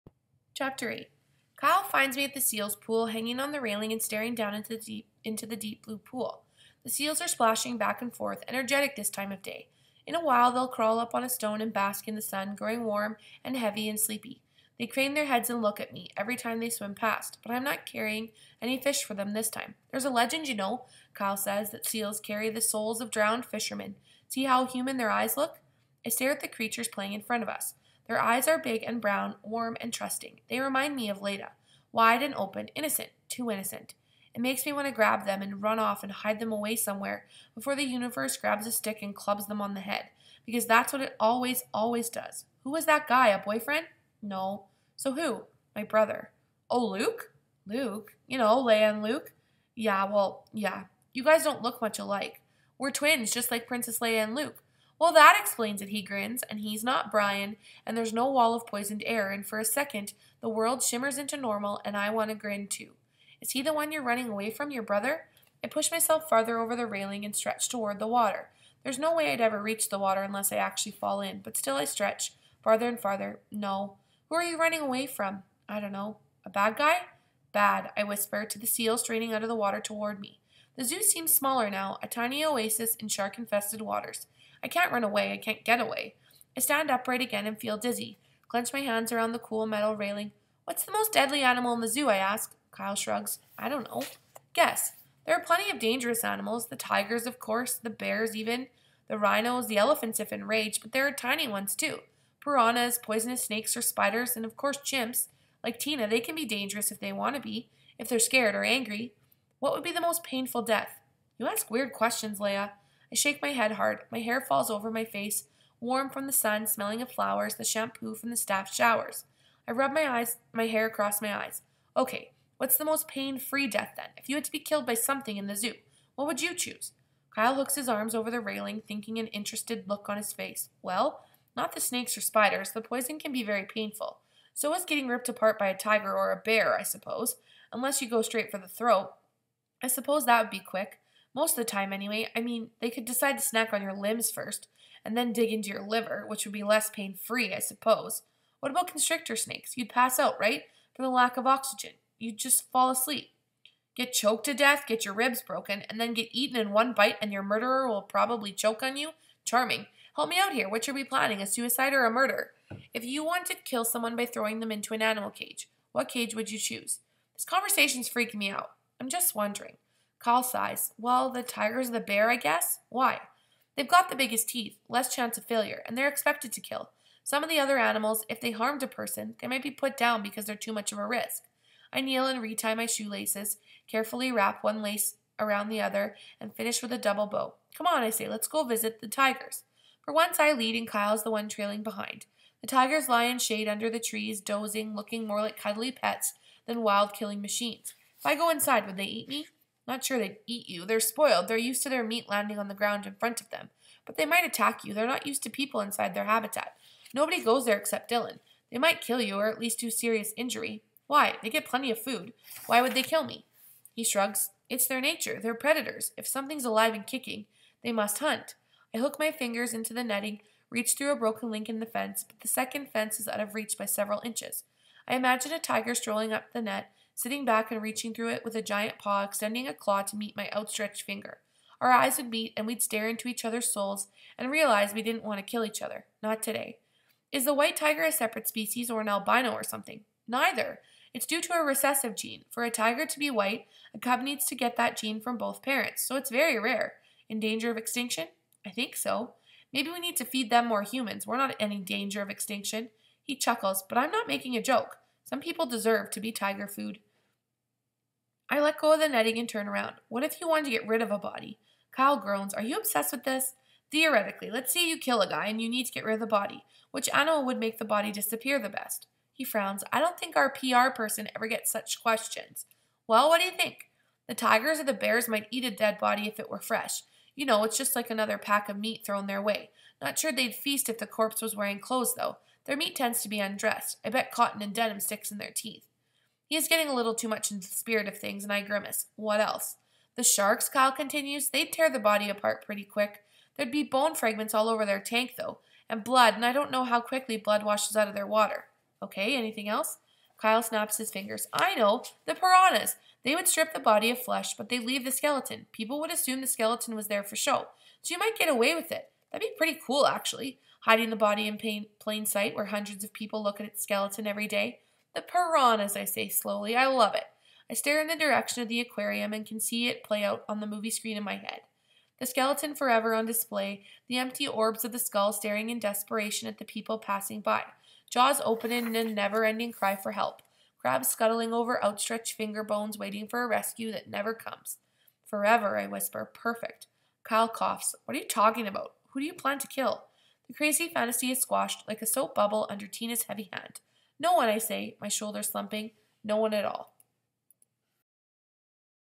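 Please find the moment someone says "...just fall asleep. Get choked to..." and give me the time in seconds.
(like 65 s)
152 s.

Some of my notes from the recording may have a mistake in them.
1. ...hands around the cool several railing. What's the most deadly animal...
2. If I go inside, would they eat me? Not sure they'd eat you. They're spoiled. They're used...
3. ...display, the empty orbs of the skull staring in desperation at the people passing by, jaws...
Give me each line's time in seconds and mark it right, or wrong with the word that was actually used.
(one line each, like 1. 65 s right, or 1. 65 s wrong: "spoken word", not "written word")
1. 88 s wrong: "metal", not "several"
2. 198 s right
3. 323 s right.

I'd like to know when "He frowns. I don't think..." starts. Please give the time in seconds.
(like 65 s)
269 s.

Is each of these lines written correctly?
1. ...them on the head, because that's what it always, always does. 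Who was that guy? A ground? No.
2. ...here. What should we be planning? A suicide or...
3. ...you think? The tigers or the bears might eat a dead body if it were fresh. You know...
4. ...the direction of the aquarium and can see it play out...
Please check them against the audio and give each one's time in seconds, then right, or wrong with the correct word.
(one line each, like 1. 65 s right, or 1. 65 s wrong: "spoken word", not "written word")
1. 39 s wrong: "boyfriend", not "ground"
2. 160 s right
3. 273 s right
4. 318 s right.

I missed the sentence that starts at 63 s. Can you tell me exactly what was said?
Is he the one you're running away from, your brother?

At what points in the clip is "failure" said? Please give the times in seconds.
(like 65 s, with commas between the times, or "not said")
175 s.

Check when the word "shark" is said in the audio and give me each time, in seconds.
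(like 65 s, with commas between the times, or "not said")
83 s, 290 s.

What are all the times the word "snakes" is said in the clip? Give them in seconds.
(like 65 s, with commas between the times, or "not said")
103 s, 131 s, 149 s.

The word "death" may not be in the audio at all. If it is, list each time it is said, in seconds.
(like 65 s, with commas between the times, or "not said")
110 s, 123 s, 154 s.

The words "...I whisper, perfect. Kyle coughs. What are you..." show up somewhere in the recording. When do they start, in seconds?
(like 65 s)
335 s.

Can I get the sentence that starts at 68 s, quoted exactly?
There's no way I'd ever reach the water unless I actually fall in, but still I stretch, farther and farther.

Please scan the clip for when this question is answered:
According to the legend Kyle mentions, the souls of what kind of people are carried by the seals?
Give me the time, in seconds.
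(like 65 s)
23 s.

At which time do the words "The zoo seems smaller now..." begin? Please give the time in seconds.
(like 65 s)
80 s.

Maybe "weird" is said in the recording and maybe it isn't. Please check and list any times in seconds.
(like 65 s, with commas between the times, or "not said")
111 s.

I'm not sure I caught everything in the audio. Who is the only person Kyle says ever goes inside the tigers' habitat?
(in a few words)
Dylan.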